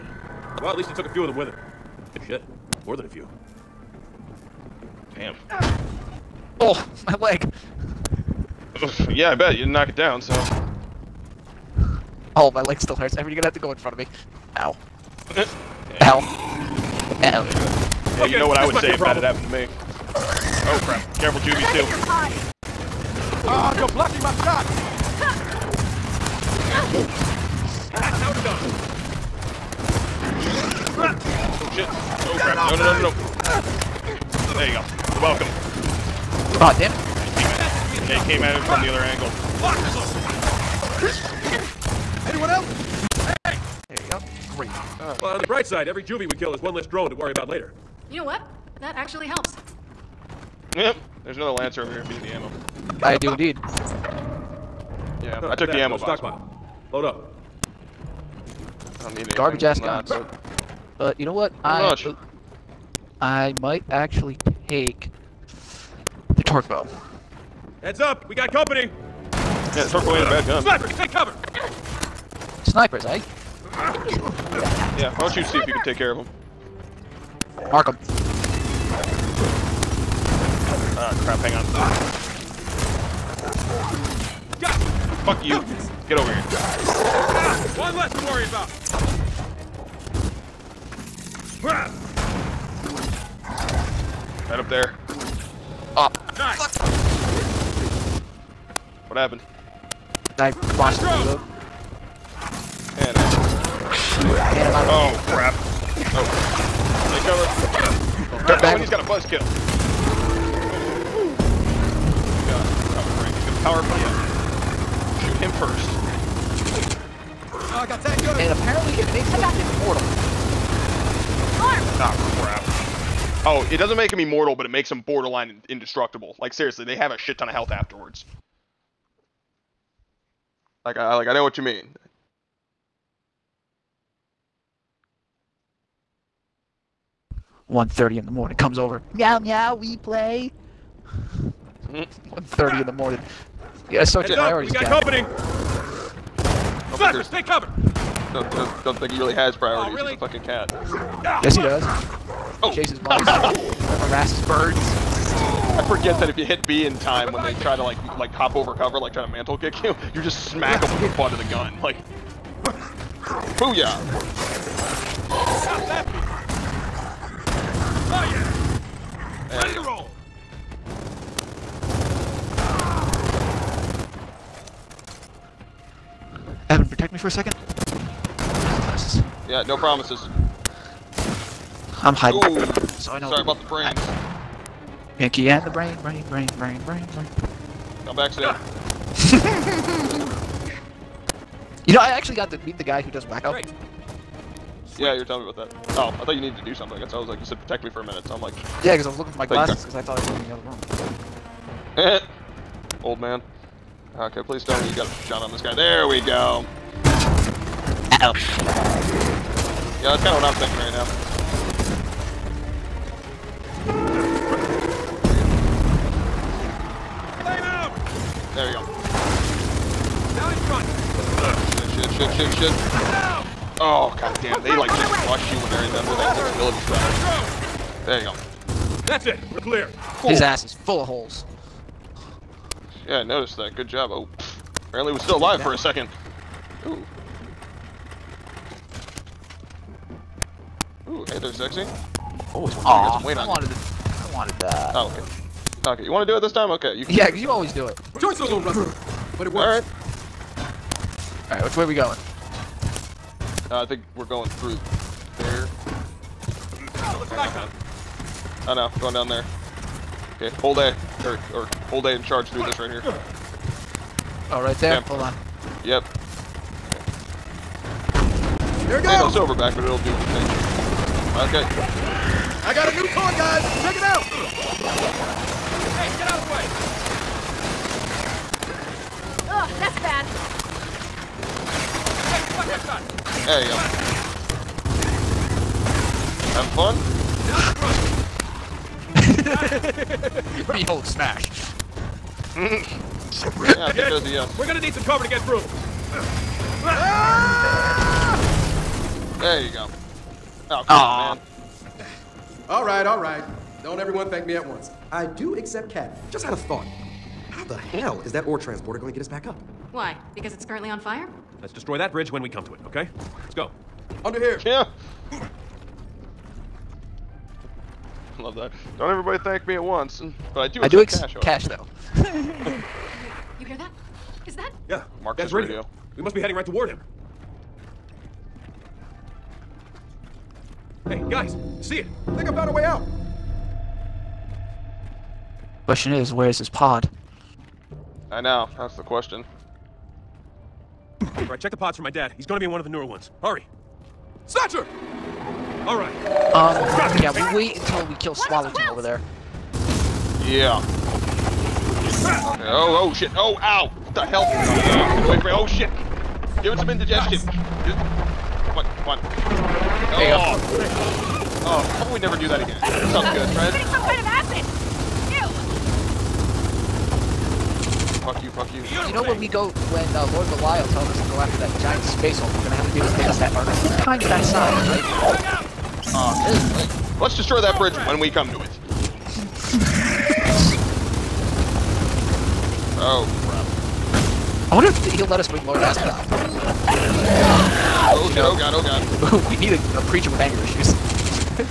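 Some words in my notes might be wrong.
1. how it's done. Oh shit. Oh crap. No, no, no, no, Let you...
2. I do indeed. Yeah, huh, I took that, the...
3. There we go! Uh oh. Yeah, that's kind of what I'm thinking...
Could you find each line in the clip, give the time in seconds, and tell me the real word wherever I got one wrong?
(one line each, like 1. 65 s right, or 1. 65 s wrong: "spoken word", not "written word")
1. 26 s wrong: "There", not "Let"
2. 53 s right
3. 205 s right.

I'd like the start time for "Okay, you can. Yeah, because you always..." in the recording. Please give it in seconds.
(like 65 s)
246 s.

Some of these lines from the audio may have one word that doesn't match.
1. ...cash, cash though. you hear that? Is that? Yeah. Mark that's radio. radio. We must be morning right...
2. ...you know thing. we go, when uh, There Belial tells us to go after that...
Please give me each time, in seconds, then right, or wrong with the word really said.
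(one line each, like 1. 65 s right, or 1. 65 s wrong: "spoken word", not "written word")
1. 321 s wrong: "heading", not "morning"
2. 369 s wrong: "Lord", not "There".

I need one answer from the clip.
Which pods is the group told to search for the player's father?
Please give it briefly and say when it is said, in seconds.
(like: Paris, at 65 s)
The newer ones, at 342 s.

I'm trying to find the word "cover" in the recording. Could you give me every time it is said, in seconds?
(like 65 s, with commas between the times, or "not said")
71 s, 147 s, 158 s, 295 s.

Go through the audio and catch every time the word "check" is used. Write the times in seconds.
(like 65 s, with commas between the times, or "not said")
273 s, 341 s.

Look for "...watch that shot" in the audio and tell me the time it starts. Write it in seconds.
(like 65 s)
282 s.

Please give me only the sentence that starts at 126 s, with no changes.
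Like seriously, they have a shit ton of health afterwards.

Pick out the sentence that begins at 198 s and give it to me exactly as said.
Yeah, because I was looking for my glasses, because I thought I was in the other room.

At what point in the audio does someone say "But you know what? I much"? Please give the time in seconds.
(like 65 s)
60 s.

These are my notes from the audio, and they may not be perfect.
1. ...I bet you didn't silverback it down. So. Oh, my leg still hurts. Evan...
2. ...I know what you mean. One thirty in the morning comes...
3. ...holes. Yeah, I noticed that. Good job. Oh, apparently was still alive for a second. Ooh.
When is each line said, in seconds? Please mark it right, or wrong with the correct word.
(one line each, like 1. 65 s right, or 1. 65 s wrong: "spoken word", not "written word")
1. 9 s wrong: "knock", not "silverback"
2. 131 s right
3. 231 s right.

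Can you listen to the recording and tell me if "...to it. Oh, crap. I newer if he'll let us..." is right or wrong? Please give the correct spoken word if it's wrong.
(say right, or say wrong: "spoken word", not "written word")
wrong: "wonder", not "newer".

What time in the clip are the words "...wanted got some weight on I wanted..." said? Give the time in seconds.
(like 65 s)
242 s.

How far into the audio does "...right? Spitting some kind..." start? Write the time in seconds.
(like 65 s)
363 s.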